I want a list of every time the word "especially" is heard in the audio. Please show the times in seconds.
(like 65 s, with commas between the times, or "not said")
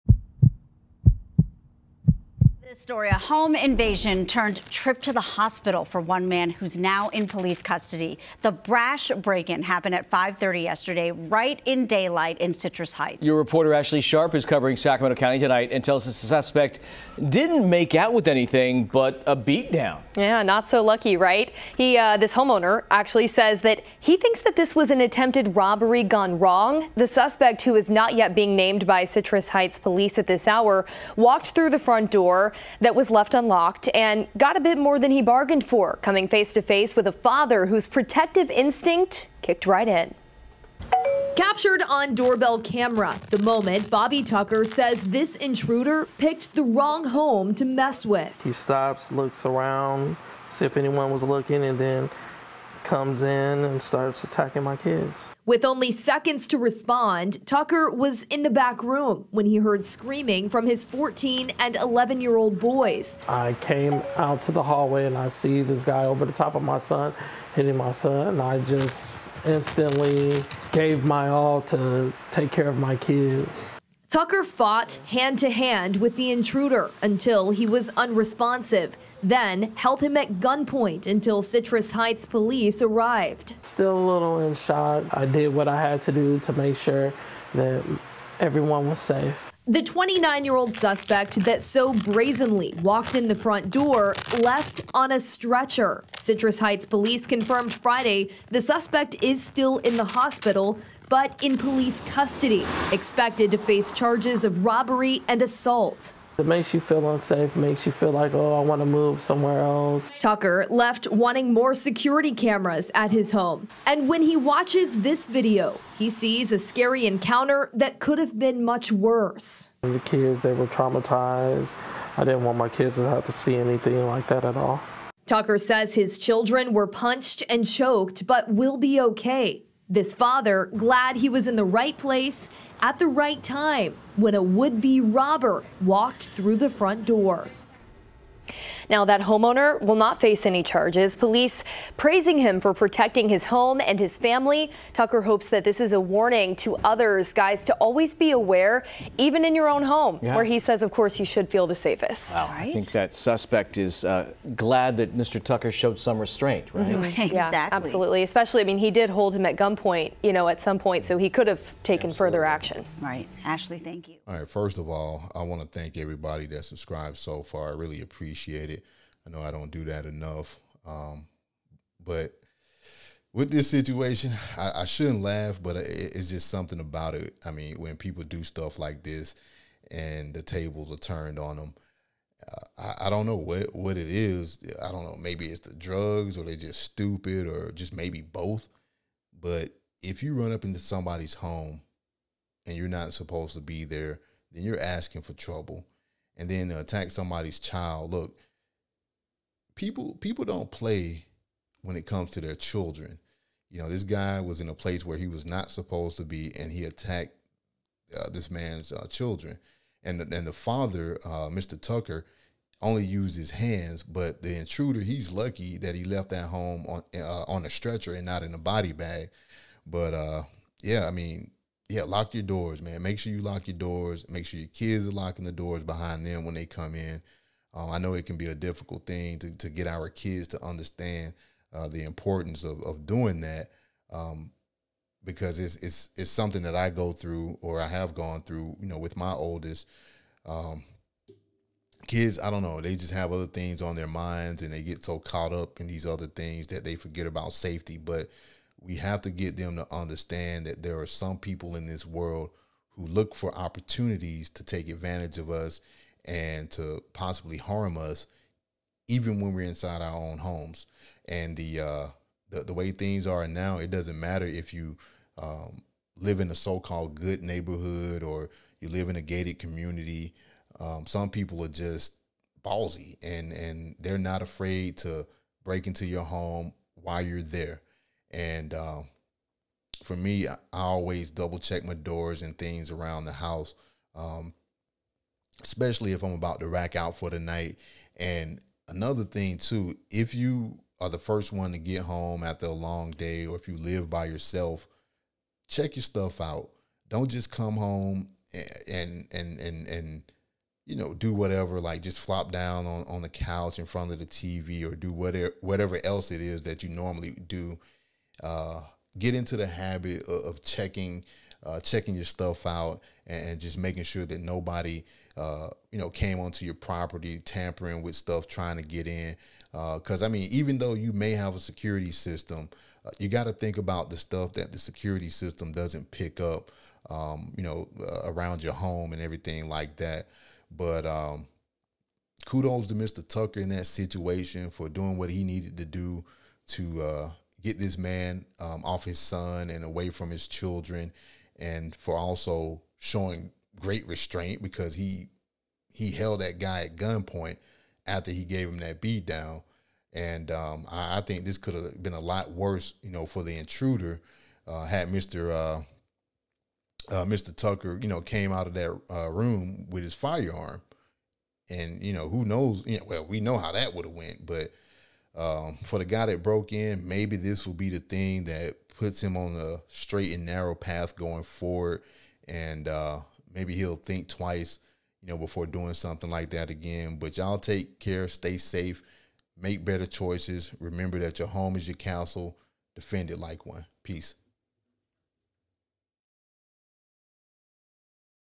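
158 s, 285 s.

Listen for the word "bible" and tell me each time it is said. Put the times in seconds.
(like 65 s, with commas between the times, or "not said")
not said.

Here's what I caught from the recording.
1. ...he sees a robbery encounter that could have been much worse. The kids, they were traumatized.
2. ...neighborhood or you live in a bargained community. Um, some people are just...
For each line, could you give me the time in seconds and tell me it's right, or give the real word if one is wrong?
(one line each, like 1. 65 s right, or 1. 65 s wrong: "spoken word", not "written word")
1. 115 s wrong: "scary", not "robbery"
2. 267 s wrong: "gated", not "bargained".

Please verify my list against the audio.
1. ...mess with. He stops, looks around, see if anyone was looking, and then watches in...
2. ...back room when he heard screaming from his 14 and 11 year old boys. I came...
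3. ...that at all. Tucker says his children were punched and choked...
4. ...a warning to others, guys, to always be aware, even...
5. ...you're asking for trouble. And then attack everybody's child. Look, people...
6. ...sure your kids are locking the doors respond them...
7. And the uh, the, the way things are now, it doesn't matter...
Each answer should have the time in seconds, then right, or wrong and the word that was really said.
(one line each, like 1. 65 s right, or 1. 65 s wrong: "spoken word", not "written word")
1. 47 s wrong: "comes", not "watches"
2. 58 s right
3. 124 s right
4. 145 s right
5. 194 s wrong: "somebody", not "everybody"
6. 224 s wrong: "behind", not "respond"
7. 261 s right.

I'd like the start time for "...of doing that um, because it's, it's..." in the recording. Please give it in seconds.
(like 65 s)
232 s.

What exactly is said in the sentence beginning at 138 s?
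Now, that homeowner will not face any charges.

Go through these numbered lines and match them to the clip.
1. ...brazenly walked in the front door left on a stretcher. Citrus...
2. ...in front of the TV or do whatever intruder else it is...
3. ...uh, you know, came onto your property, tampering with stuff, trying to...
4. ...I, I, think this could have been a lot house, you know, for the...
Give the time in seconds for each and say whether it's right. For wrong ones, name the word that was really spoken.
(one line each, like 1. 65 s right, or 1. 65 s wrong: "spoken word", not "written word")
1. 91 s right
2. 303 s wrong: "whatever", not "intruder"
3. 315 s right
4. 350 s wrong: "worse", not "house".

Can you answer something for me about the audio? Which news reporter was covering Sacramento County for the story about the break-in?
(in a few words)
Ashley Sharp.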